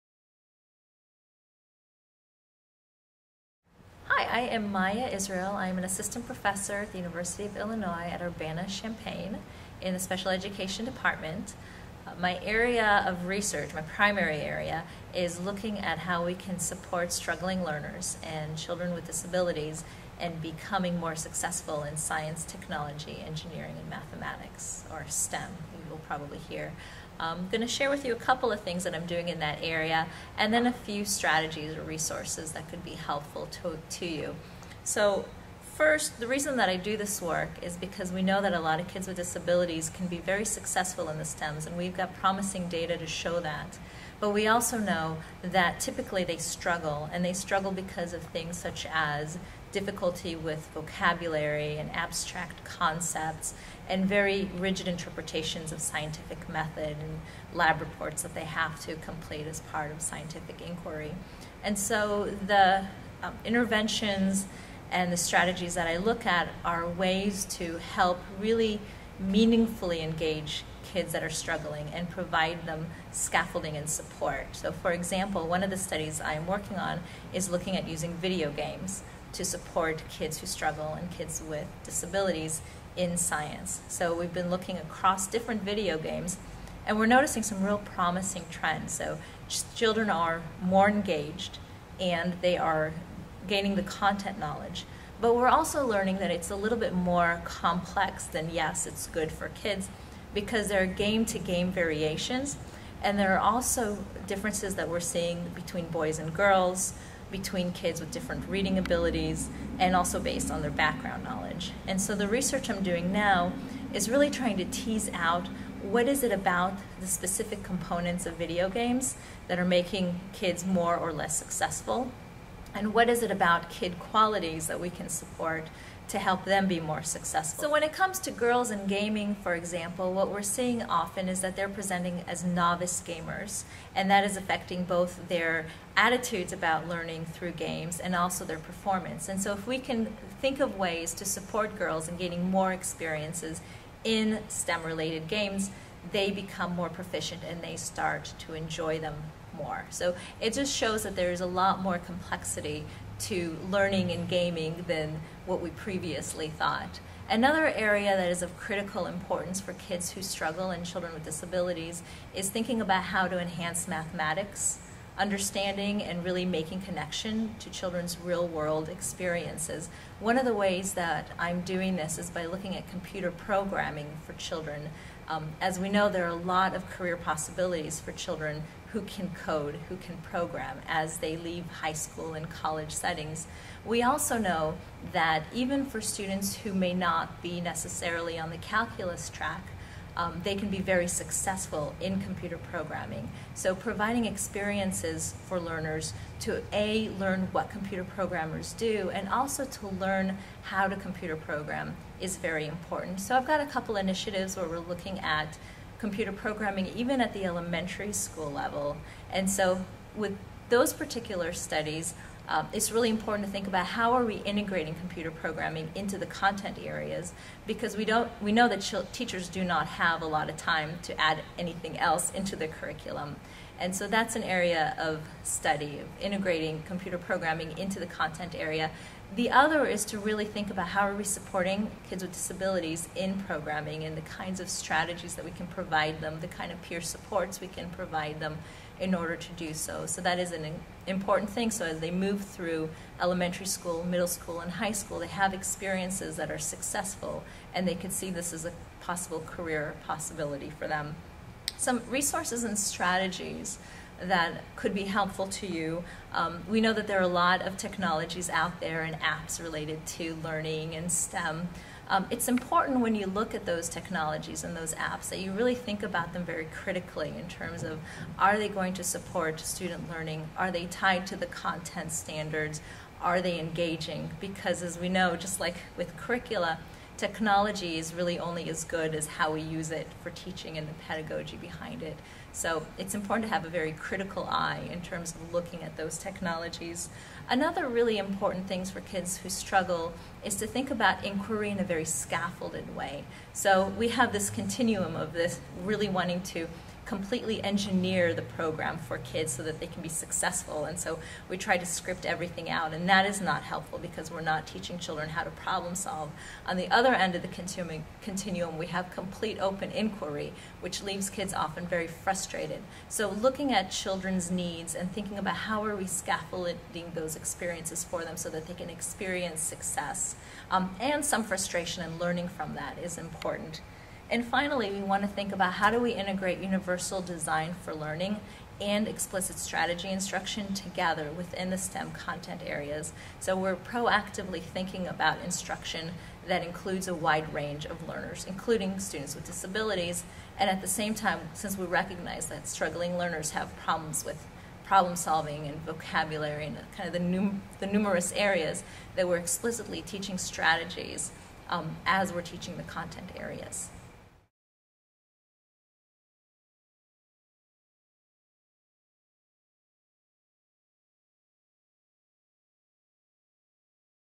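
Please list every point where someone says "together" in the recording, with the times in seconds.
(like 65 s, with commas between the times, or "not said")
330 s.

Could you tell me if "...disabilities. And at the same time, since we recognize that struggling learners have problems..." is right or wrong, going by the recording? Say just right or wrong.
right.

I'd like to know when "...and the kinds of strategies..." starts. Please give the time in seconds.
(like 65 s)
234 s.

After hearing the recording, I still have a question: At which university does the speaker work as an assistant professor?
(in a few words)
University of Illinois at Urbana-Champaign.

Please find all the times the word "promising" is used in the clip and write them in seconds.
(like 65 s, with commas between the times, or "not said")
42 s, 87 s.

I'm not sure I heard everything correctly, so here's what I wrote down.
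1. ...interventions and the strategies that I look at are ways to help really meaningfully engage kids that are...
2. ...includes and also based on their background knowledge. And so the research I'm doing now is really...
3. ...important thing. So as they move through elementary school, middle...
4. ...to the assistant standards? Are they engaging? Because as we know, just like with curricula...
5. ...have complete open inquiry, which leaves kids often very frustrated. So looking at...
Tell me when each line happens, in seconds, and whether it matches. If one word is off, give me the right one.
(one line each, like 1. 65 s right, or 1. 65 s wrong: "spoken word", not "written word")
1. 63 s right
2. 108 s wrong: "abilities", not "includes"
3. 241 s right
4. 271 s wrong: "content", not "assistant"
5. 308 s right.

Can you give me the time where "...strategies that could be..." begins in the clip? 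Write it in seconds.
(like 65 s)
252 s.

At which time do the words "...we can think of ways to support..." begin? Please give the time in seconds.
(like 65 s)
139 s.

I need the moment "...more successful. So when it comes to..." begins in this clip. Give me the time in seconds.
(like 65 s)
126 s.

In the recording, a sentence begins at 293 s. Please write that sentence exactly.
So we have this continuum of this really wanting to completely engineer the program for kids so that they can be successful.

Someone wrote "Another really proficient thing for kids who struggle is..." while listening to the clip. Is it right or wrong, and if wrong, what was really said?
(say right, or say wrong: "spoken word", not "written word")
wrong: "important", not "proficient".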